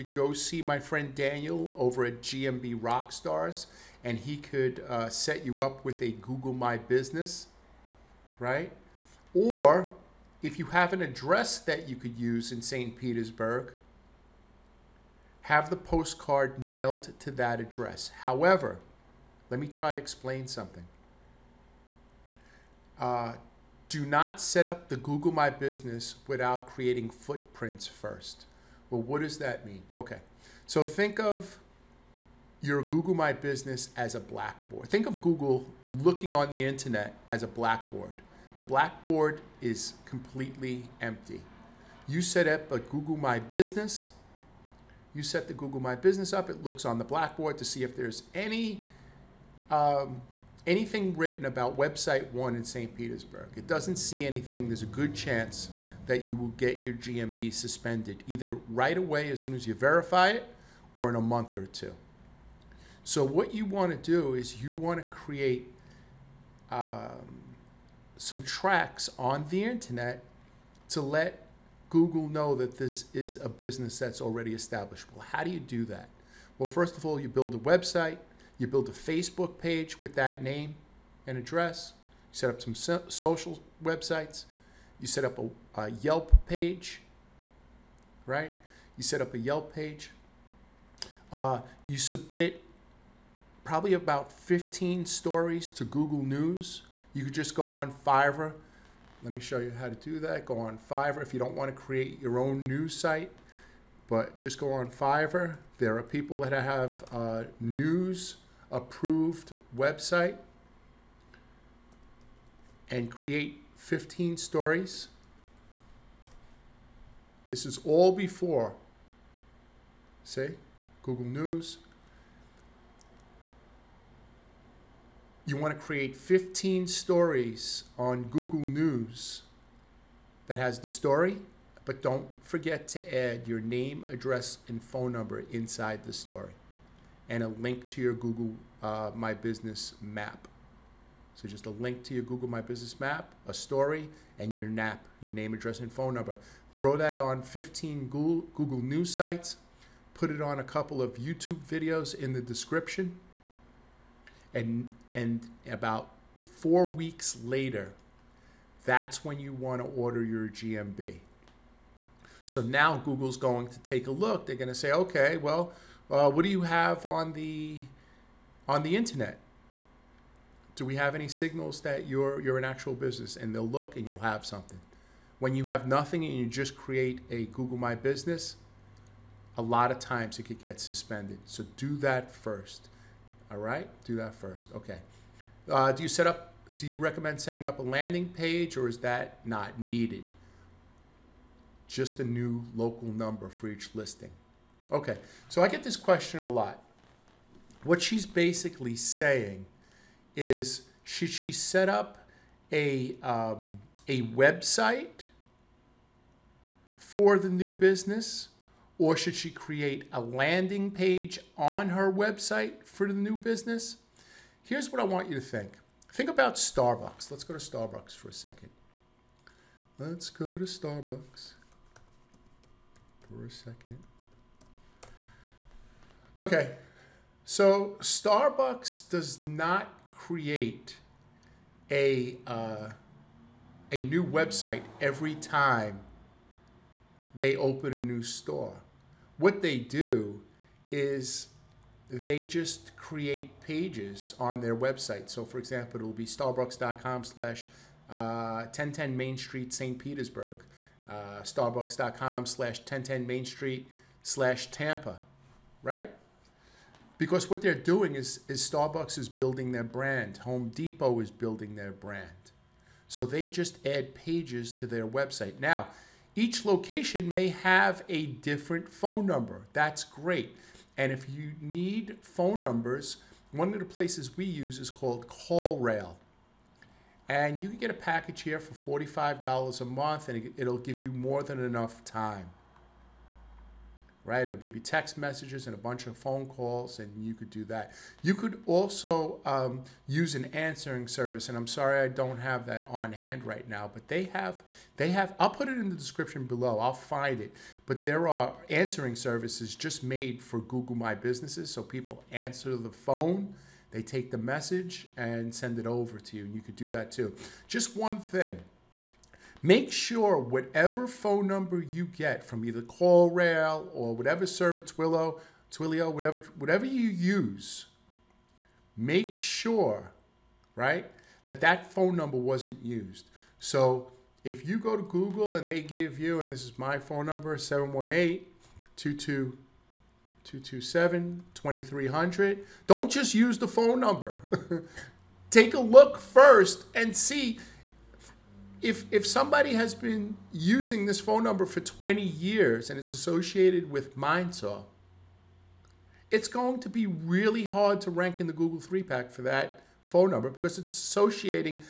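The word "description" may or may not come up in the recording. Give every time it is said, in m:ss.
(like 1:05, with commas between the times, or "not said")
2:32, 4:55.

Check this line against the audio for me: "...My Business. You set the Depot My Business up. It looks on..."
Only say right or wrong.
wrong.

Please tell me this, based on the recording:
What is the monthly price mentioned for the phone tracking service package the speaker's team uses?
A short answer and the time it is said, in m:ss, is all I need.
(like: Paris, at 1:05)
$45, at 4:38.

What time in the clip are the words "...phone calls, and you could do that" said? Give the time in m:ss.
4:46.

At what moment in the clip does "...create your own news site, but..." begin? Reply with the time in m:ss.
1:41.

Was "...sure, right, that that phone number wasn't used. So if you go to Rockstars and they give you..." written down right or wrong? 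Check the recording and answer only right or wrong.
wrong.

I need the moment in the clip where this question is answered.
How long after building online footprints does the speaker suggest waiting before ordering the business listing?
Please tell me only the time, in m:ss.
2:35.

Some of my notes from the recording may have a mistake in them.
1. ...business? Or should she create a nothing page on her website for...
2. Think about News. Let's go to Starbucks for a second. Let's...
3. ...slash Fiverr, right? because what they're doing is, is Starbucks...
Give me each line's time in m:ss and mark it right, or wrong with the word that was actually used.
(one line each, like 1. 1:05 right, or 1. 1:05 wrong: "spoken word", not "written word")
1. 3:27 wrong: "landing", not "nothing"
2. 3:36 wrong: "Starbucks", not "News"
3. 4:14 wrong: "Tampa", not "Fiverr".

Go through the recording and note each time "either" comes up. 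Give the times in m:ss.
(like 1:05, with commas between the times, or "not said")
0:58, 5:12.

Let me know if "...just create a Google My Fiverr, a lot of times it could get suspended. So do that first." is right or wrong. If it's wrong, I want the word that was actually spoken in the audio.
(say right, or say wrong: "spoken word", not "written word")
wrong: "Business", not "Fiverr".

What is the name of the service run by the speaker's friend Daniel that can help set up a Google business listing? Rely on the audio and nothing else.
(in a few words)
GMB Rockstars.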